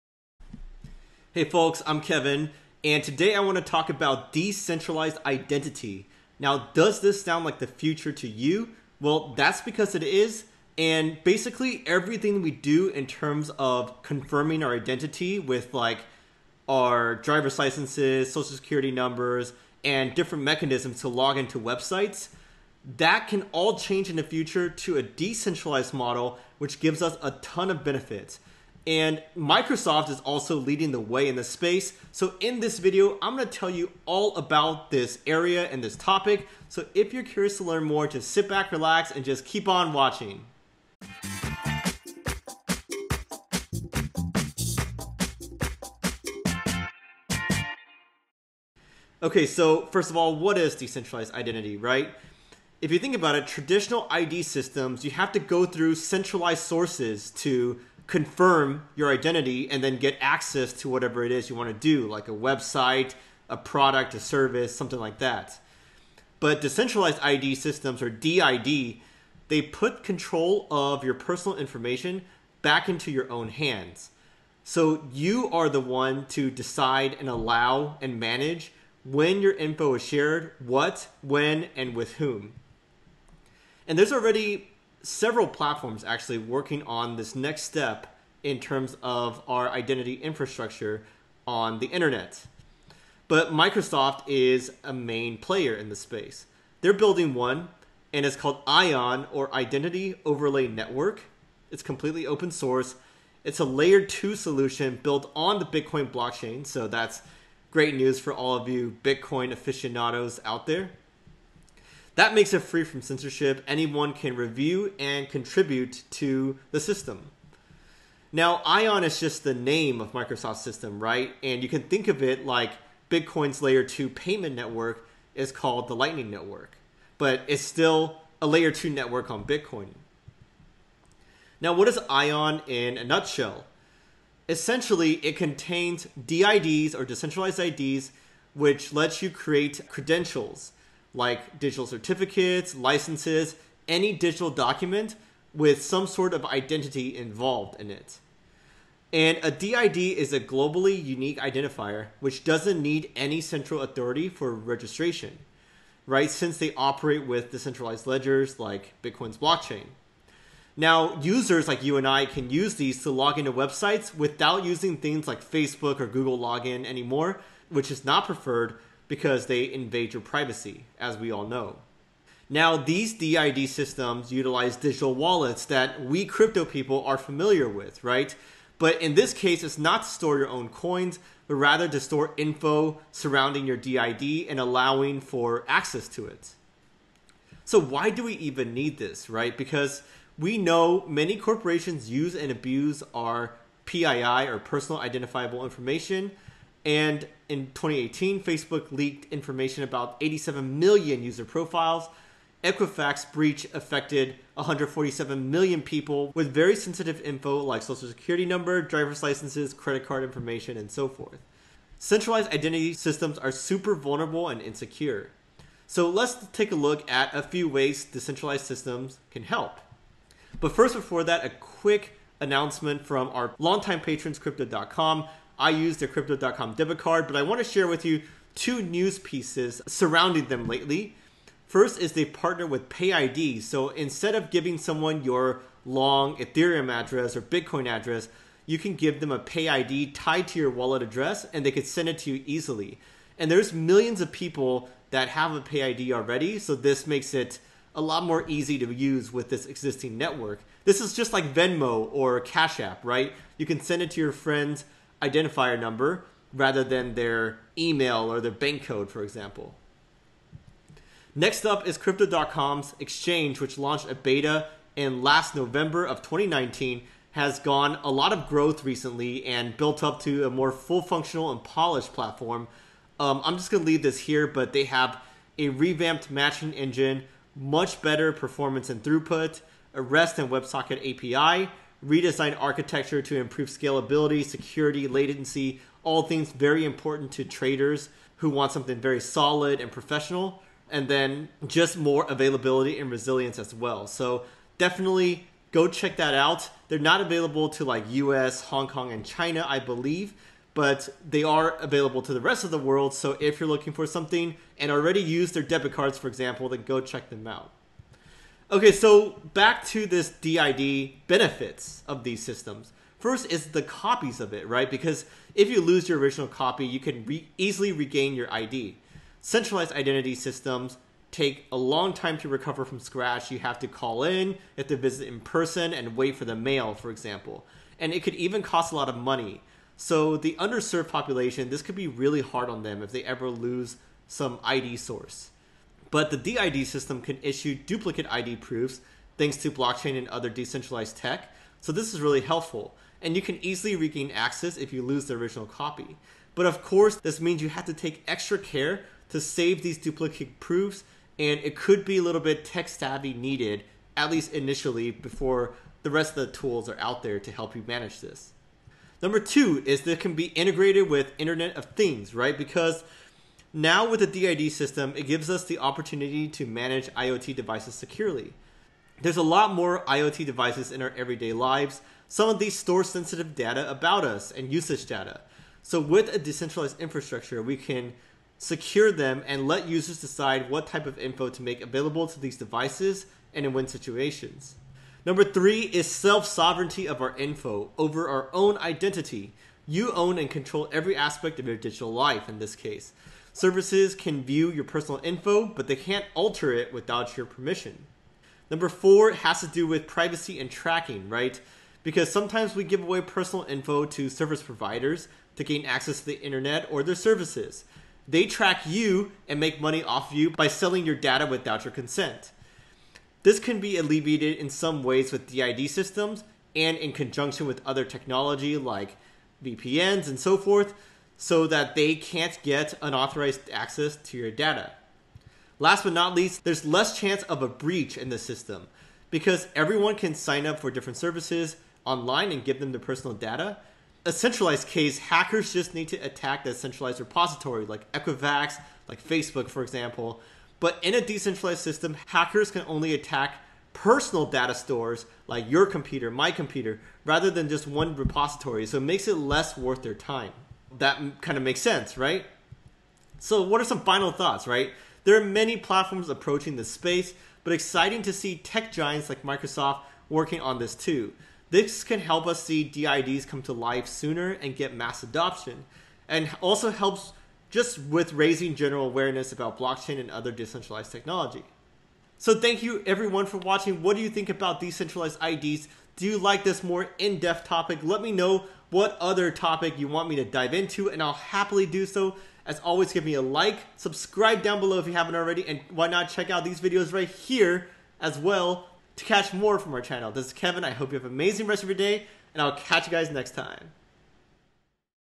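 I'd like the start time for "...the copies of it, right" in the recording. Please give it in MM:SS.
05:13.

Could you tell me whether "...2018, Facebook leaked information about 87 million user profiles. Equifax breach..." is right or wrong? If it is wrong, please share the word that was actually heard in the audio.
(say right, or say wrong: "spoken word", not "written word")
right.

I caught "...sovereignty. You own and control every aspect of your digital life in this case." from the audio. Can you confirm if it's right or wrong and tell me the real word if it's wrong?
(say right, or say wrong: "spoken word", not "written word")
wrong: "identity", not "sovereignty".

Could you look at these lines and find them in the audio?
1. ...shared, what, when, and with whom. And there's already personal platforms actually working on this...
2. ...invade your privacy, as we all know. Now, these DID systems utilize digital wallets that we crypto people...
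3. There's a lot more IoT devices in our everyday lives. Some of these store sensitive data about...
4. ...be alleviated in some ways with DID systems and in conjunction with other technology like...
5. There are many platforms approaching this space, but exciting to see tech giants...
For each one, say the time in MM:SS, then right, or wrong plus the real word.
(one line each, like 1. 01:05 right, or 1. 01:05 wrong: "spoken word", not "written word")
1. 01:20 wrong: "several", not "personal"
2. 02:49 right
3. 06:09 right
4. 06:53 right
5. 07:35 right.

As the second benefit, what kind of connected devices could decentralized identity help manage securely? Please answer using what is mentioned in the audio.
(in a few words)
Internet of Things.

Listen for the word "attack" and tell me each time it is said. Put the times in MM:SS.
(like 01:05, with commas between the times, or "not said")
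07:16, 07:23.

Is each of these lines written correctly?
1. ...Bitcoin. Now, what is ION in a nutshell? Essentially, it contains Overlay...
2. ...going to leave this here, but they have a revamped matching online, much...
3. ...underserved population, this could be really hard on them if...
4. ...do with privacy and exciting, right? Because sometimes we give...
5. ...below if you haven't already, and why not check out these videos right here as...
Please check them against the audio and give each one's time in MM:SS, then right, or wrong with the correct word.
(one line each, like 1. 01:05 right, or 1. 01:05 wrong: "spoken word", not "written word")
1. 02:09 wrong: "DIDs", not "Overlay"
2. 04:33 wrong: "engine", not "online"
3. 05:30 right
4. 06:39 wrong: "tracking", not "exciting"
5. 08:04 right.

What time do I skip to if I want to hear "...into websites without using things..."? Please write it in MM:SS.
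02:43.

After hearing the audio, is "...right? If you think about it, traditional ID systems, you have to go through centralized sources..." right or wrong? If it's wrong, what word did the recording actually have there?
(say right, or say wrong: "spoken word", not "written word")
right.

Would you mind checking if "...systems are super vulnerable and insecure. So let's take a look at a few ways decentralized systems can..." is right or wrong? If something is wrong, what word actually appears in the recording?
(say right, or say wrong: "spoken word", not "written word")
right.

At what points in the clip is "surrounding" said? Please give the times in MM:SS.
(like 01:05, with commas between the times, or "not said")
03:03, 03:49.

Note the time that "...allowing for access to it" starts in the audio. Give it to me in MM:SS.
03:04.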